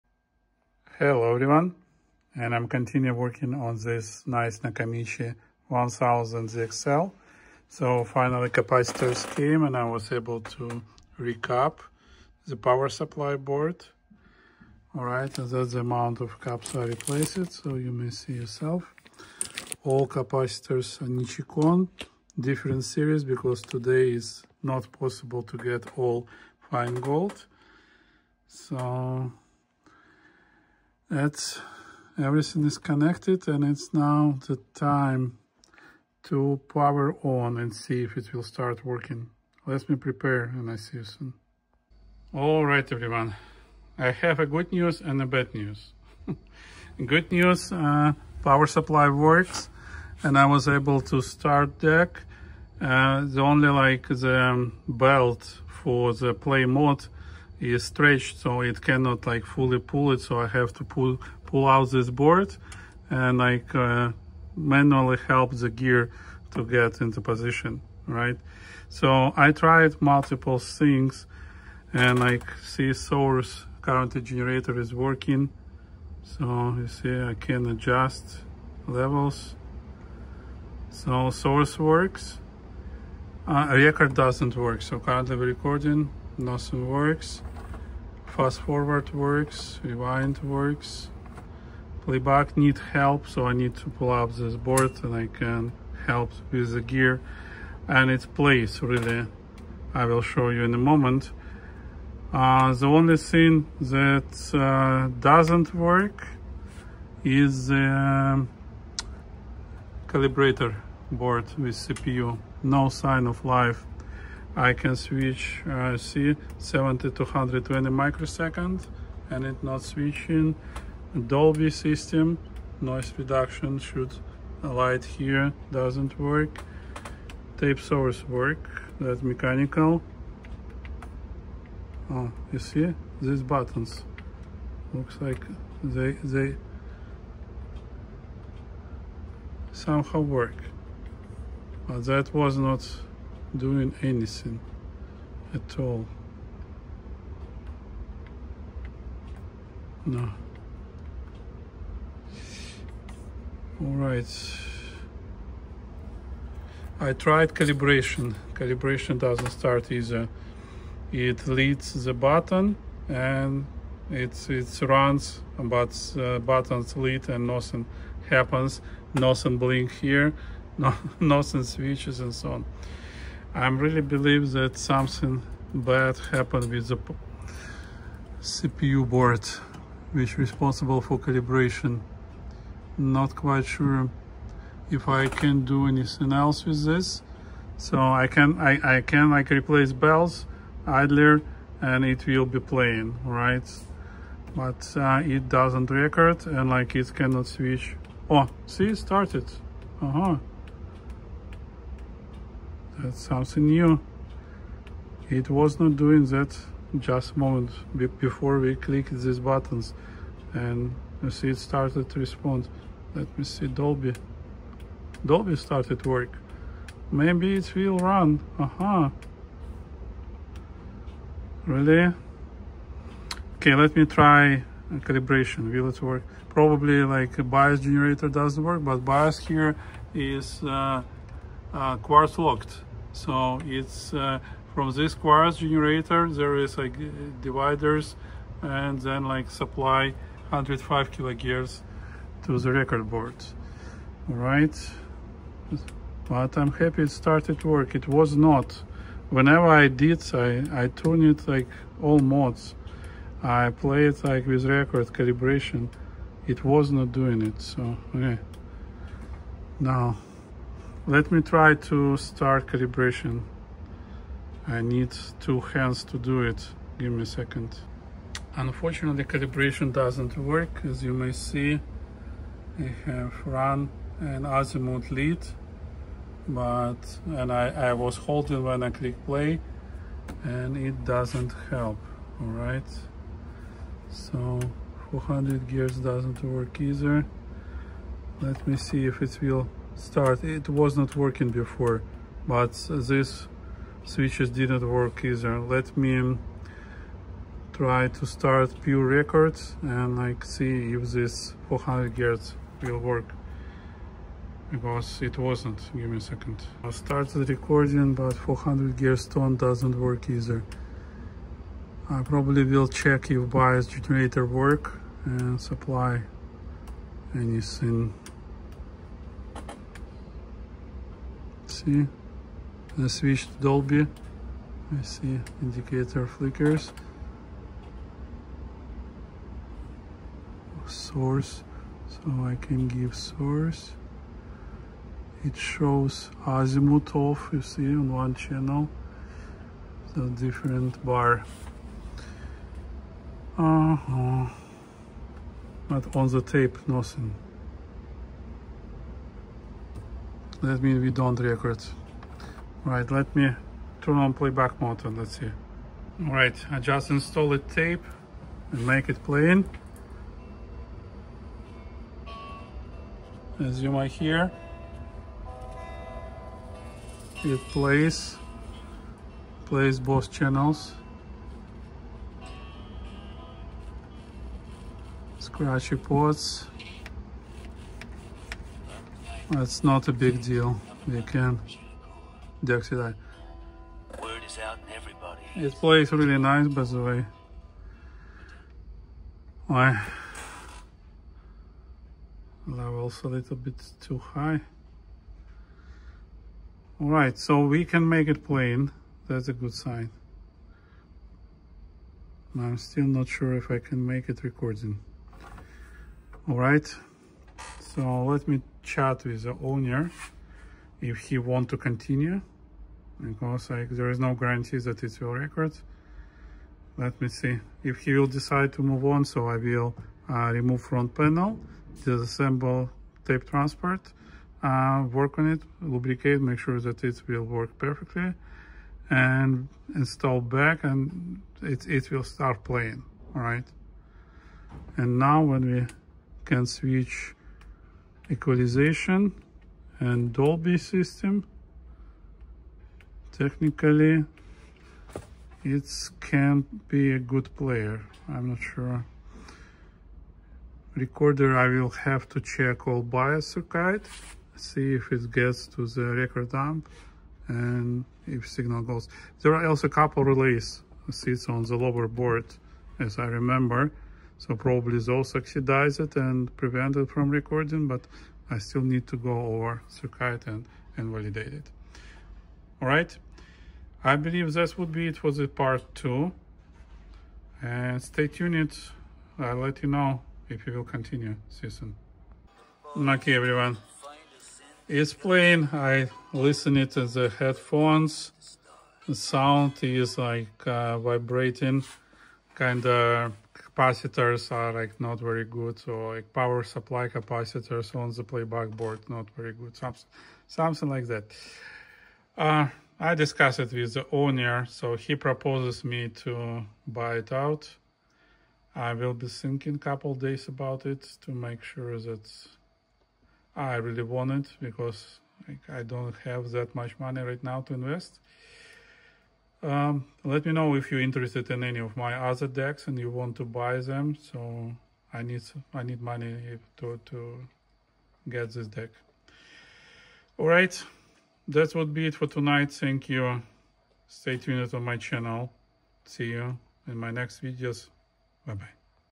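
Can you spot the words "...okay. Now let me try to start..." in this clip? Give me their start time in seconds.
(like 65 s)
258 s.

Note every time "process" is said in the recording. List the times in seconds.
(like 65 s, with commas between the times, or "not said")
not said.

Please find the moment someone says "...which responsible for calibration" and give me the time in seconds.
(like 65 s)
180 s.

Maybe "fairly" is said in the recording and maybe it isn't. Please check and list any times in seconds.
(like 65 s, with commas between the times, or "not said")
not said.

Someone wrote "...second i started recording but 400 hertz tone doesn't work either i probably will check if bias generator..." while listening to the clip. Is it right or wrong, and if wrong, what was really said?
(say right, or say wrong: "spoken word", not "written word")
right.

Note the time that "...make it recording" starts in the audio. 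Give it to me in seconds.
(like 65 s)
404 s.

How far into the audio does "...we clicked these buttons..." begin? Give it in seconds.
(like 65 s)
208 s.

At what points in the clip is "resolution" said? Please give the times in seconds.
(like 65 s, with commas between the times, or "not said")
not said.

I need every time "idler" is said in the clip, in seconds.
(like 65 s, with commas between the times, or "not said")
190 s.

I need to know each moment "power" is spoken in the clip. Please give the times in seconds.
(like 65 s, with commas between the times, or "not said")
12 s, 36 s, 48 s, 496 s.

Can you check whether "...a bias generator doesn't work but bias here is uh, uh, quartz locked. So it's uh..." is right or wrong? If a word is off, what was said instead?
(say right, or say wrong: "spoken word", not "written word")
right.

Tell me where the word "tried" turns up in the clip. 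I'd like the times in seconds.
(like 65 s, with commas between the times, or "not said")
69 s, 157 s.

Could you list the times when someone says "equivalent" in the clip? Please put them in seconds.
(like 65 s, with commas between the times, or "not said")
not said.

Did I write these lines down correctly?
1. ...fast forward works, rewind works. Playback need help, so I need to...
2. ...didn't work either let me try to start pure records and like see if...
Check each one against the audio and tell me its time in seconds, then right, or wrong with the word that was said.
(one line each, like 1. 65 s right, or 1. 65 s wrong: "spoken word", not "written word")
1. 88 s right
2. 294 s right.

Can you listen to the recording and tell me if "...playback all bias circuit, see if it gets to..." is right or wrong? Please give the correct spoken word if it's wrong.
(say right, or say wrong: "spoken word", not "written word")
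wrong: "check", not "playback".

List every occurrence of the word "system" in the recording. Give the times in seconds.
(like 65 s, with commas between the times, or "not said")
121 s, 440 s.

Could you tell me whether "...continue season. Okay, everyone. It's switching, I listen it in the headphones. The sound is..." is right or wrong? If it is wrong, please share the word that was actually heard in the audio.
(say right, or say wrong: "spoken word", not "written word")
wrong: "playing", not "switching".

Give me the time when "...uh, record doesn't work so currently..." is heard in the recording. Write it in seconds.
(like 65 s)
83 s.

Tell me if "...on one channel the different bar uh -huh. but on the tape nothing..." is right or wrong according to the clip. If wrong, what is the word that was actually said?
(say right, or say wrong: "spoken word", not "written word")
right.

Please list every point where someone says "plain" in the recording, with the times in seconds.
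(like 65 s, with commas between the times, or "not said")
359 s, 398 s.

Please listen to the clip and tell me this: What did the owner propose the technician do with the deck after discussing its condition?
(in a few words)
Buy it out.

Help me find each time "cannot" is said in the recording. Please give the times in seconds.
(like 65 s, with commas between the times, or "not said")
58 s, 197 s.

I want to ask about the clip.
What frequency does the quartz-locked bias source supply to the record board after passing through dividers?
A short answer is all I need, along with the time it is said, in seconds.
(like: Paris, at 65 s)
105 kilohertz, at 240 s.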